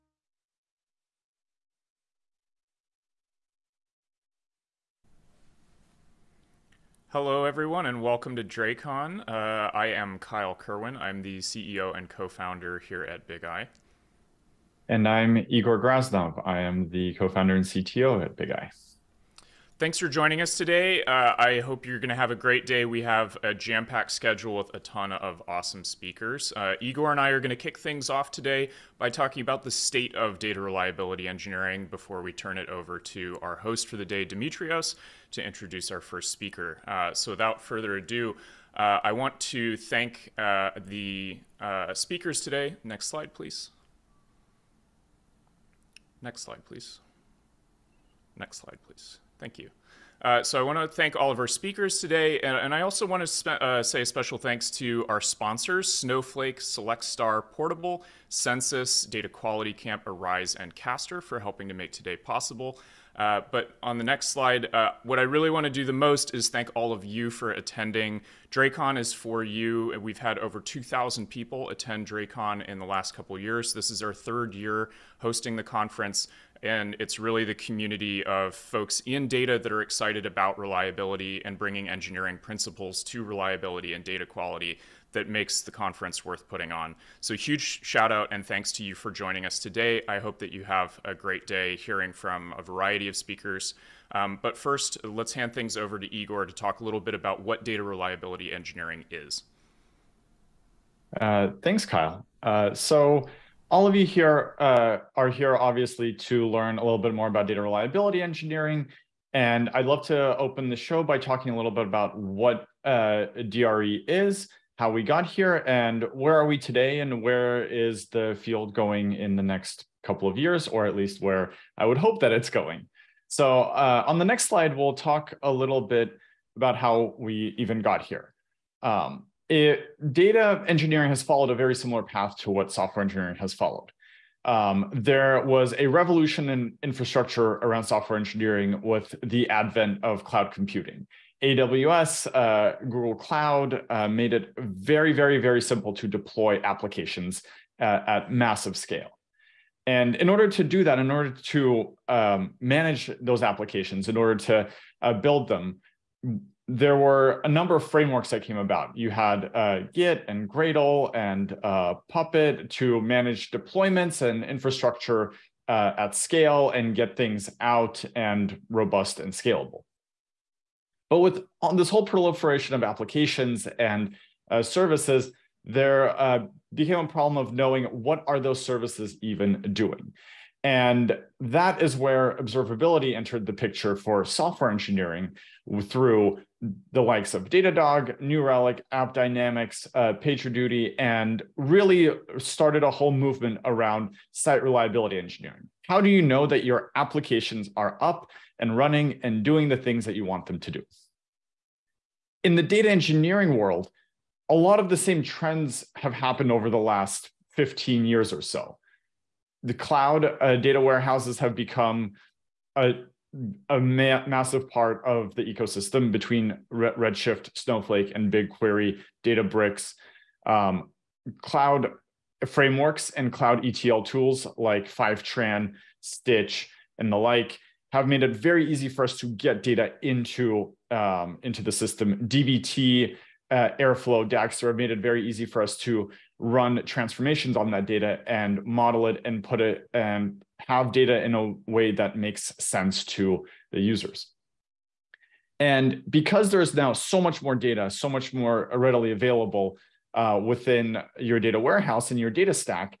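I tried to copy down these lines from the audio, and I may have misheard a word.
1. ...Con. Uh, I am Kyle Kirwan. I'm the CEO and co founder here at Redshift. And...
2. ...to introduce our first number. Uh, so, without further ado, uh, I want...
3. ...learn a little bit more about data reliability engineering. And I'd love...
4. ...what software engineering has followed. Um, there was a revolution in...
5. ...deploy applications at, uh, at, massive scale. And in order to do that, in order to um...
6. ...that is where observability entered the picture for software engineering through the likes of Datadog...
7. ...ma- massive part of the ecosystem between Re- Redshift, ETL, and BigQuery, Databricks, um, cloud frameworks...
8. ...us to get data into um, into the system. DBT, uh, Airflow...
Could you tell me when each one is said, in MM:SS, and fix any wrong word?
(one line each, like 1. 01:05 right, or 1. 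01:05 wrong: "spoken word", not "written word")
1. 00:08 wrong: "Bigeye", not "Redshift"
2. 00:35 wrong: "speaker", not "number"
3. 01:46 right
4. 02:12 right
5. 02:26 right
6. 03:01 right
7. 03:33 wrong: "Snowflake", not "ETL"
8. 03:49 right.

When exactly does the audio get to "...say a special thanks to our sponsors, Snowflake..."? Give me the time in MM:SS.
00:53.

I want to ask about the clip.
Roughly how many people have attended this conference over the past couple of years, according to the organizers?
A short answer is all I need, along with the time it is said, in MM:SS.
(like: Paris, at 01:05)
over 2,000, at 01:10.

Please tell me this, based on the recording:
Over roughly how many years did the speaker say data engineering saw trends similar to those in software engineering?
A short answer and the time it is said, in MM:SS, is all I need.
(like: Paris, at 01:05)
15 years, at 03:27.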